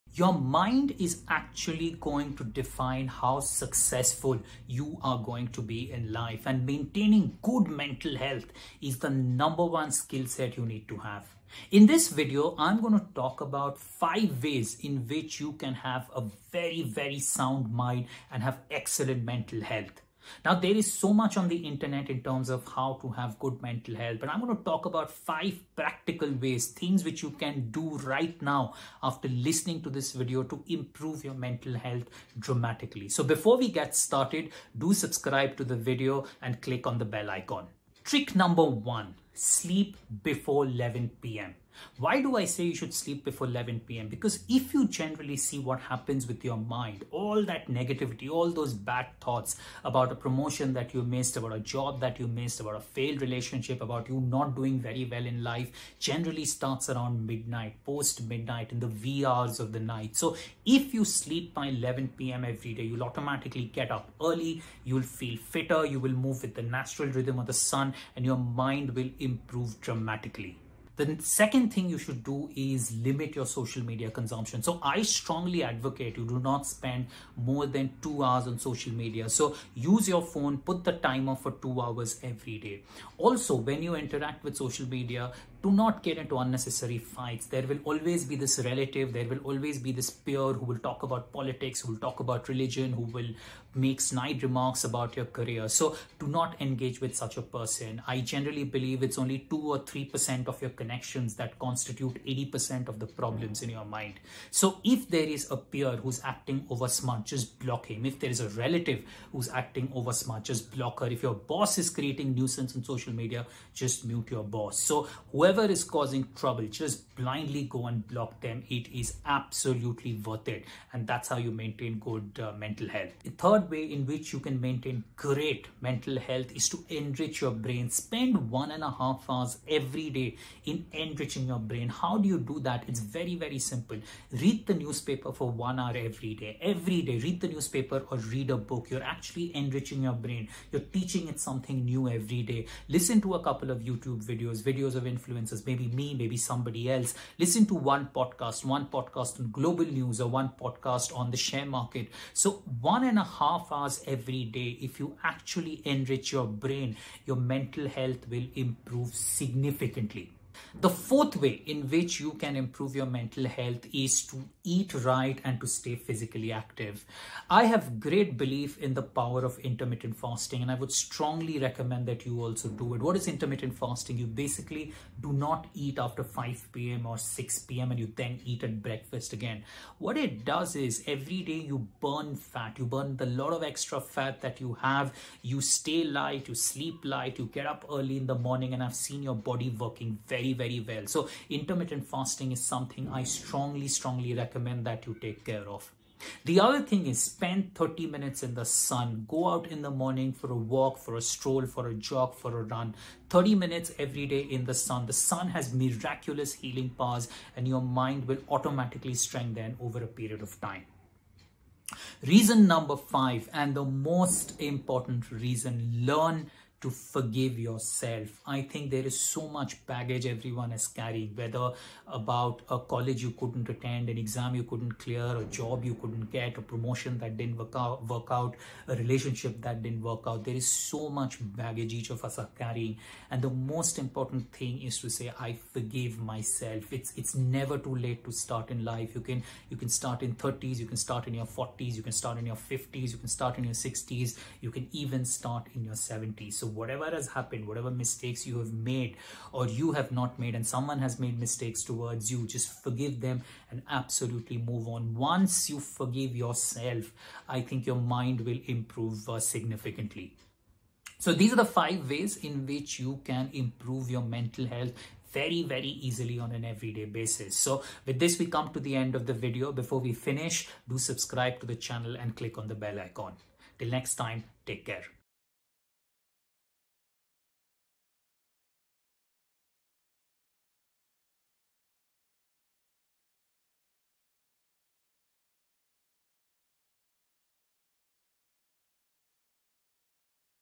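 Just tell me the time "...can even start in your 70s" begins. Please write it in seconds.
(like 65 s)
244 s.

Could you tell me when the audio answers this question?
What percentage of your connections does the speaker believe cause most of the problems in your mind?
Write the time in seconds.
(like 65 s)
99 s.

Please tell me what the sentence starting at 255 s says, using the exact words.
Once you forgive yourself, I think your mind will improve uh, significantly.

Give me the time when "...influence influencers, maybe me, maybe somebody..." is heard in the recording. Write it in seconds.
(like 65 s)
145 s.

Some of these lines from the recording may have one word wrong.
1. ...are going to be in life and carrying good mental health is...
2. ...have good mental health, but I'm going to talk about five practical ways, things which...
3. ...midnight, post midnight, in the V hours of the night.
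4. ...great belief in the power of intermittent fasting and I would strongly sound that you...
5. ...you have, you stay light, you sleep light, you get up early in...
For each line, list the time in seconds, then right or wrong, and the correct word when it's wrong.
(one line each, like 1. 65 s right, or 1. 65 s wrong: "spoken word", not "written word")
1. 5 s wrong: "maintaining", not "carrying"
2. 23 s right
3. 57 s right
4. 167 s wrong: "recommend", not "sound"
5. 184 s right.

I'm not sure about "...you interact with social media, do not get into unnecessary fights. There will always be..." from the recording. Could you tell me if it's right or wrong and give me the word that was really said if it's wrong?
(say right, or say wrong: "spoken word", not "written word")
right.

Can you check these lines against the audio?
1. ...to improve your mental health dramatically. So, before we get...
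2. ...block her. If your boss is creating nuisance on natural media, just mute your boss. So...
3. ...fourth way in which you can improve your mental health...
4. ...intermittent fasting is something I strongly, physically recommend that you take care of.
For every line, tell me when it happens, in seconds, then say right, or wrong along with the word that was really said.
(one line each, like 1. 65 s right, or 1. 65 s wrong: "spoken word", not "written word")
1. 30 s right
2. 110 s wrong: "social", not "natural"
3. 160 s right
4. 191 s wrong: "strongly", not "physically".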